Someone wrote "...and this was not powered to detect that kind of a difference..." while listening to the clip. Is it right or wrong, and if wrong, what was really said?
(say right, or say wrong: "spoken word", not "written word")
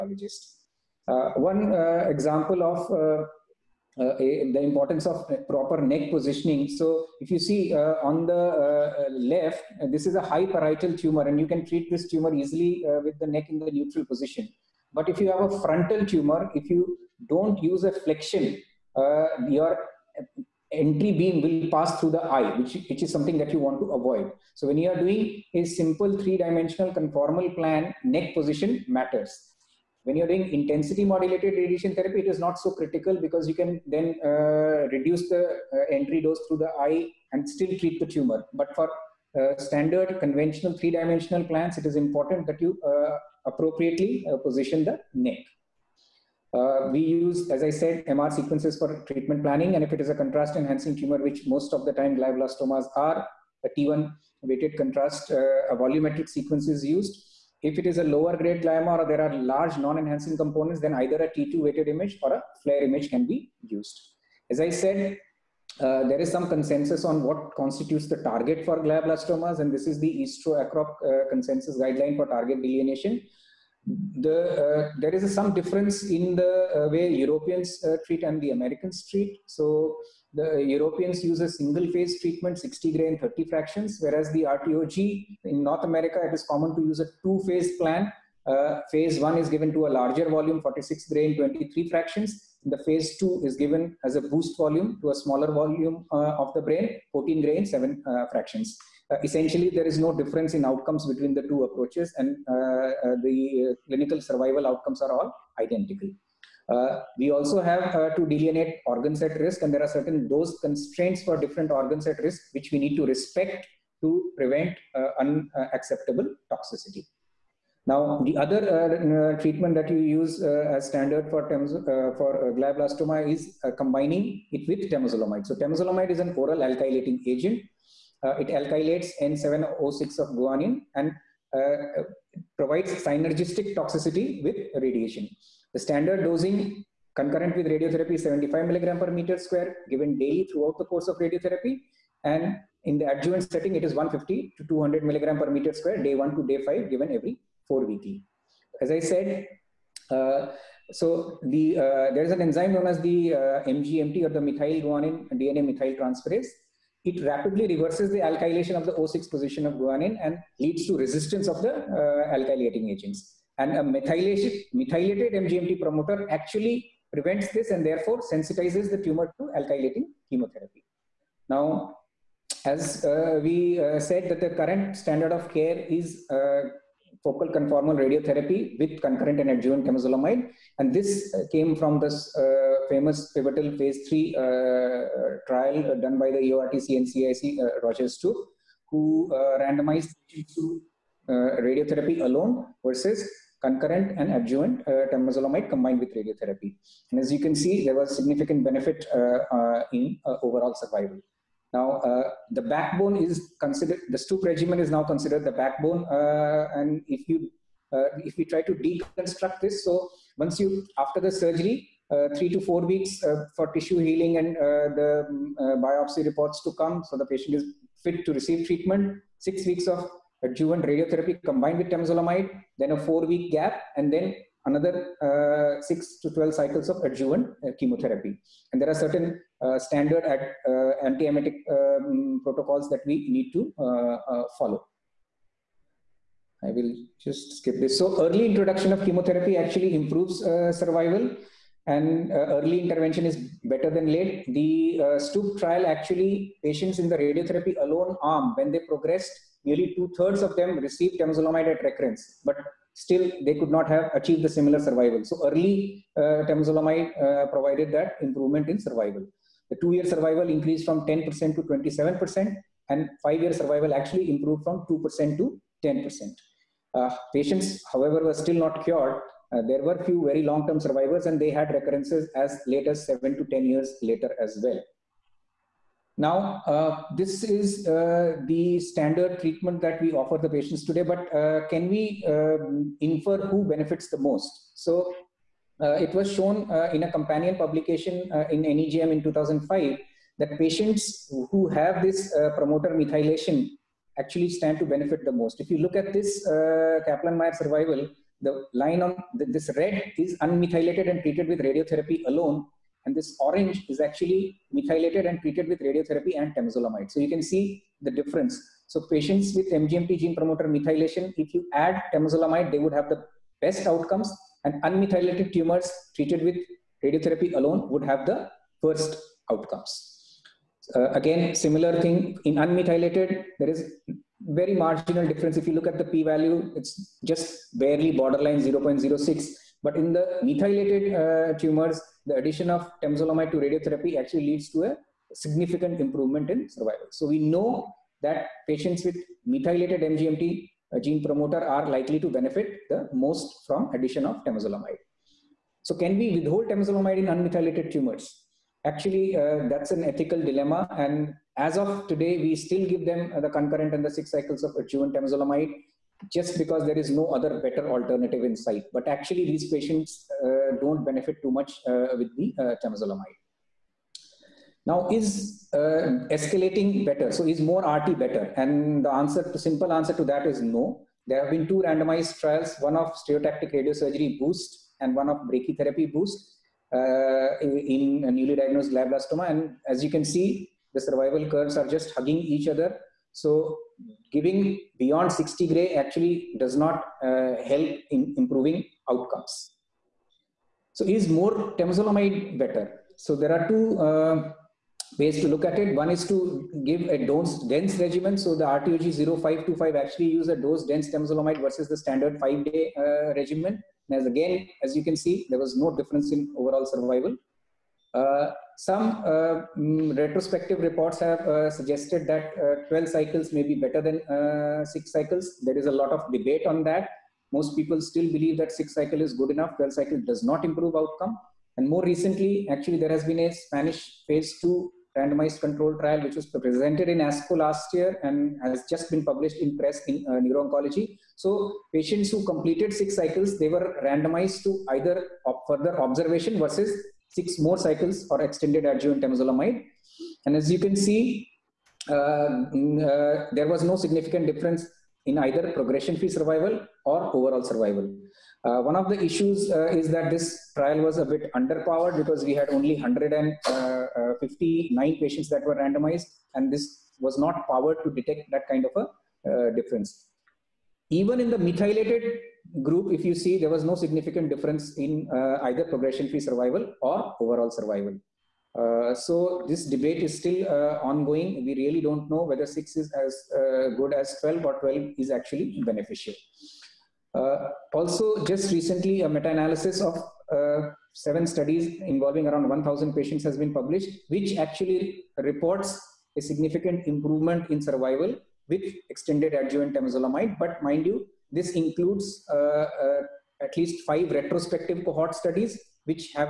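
right.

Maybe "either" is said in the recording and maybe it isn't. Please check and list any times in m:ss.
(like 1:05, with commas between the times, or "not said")
1:00, 7:14, 7:25, 7:45.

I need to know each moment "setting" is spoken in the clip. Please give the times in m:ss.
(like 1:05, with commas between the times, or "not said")
2:23.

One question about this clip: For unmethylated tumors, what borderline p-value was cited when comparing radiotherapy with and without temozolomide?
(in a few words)
0.06.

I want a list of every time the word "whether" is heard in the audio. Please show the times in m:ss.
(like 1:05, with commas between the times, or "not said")
7:52.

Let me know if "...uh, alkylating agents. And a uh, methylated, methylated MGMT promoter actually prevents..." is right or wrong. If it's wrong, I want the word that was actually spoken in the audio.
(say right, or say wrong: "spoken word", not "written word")
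right.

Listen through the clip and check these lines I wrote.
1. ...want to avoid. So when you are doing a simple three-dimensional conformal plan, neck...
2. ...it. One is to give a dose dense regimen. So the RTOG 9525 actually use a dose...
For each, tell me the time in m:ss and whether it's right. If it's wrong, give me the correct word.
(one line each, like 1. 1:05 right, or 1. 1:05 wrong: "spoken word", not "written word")
1. 0:23 right
2. 6:35 wrong: "0525", not "9525".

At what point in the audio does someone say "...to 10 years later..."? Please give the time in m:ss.
4:33.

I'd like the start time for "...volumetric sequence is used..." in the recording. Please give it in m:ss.
0:55.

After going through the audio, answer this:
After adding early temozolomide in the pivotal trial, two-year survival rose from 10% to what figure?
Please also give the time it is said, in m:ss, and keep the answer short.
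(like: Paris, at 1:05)
27%, at 4:21.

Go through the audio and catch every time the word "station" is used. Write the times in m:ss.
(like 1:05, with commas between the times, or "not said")
not said.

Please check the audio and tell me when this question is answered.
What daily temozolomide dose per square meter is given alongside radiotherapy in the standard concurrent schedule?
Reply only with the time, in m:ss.
2:18.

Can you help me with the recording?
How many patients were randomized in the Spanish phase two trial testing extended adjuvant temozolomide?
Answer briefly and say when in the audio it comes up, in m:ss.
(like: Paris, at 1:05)
159, at 7:32.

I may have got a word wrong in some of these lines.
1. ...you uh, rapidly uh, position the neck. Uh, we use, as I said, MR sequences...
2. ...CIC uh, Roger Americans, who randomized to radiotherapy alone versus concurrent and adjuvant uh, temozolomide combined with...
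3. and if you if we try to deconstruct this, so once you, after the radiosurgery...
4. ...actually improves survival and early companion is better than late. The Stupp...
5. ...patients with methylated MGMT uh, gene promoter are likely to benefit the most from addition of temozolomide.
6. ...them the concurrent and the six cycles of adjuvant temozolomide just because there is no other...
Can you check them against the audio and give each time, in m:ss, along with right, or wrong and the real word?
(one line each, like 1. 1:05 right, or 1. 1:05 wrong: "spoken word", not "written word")
1. 0:42 wrong: "appropriately", not "rapidly"
2. 3:07 wrong: "Stupp", not "Americans"
3. 3:26 wrong: "surgery", not "radiosurgery"
4. 3:59 wrong: "intervention", not "companion"
5. 5:38 right
6. 5:53 right.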